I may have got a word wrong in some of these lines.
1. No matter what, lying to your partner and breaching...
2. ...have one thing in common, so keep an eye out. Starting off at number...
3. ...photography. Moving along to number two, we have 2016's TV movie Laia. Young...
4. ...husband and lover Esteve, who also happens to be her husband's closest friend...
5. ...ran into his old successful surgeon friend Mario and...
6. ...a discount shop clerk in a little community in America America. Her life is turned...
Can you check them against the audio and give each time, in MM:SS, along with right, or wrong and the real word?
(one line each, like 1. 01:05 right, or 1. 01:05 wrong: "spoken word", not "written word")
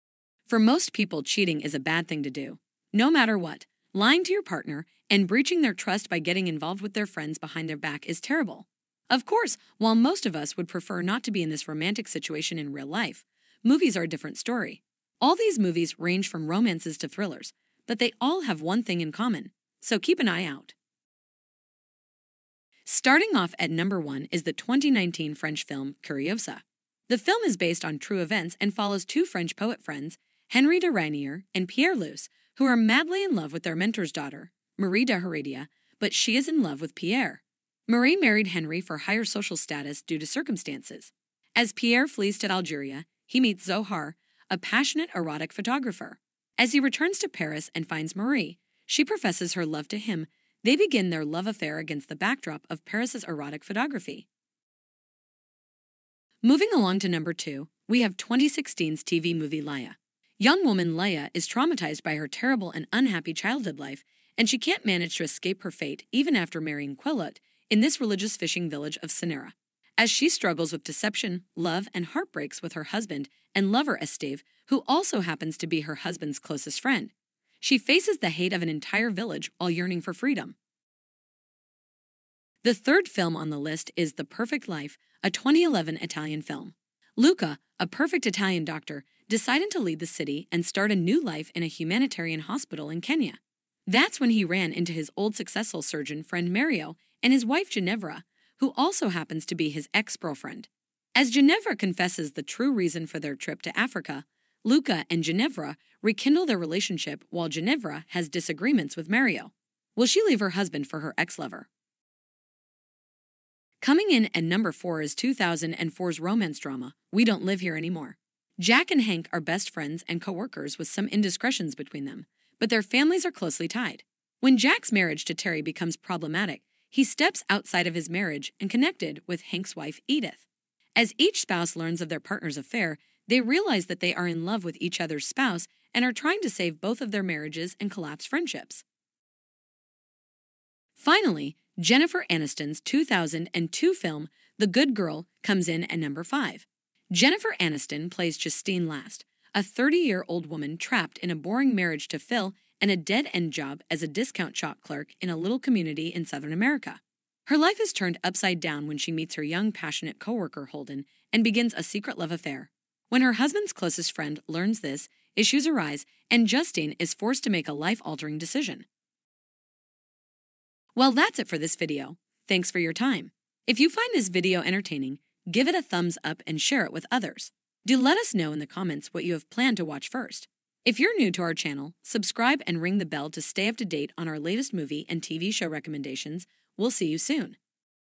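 1. 00:02 right
2. 00:18 right
3. 00:53 right
4. 01:12 right
5. 01:34 right
6. 02:34 wrong: "Southern", not "America".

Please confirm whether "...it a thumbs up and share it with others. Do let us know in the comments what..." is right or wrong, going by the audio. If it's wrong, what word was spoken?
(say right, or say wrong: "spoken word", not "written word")
right.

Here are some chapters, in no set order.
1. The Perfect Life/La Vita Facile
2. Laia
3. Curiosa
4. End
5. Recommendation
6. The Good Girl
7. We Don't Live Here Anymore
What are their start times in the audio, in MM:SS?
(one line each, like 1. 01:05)
1. 01:21
2. 00:55
3. 00:21
4. 02:50
5. 03:00
6. 02:20
7. 01:52.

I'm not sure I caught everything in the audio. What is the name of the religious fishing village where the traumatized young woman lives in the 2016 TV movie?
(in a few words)
Sinera.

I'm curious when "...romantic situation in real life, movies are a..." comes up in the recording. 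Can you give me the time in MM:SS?
00:11.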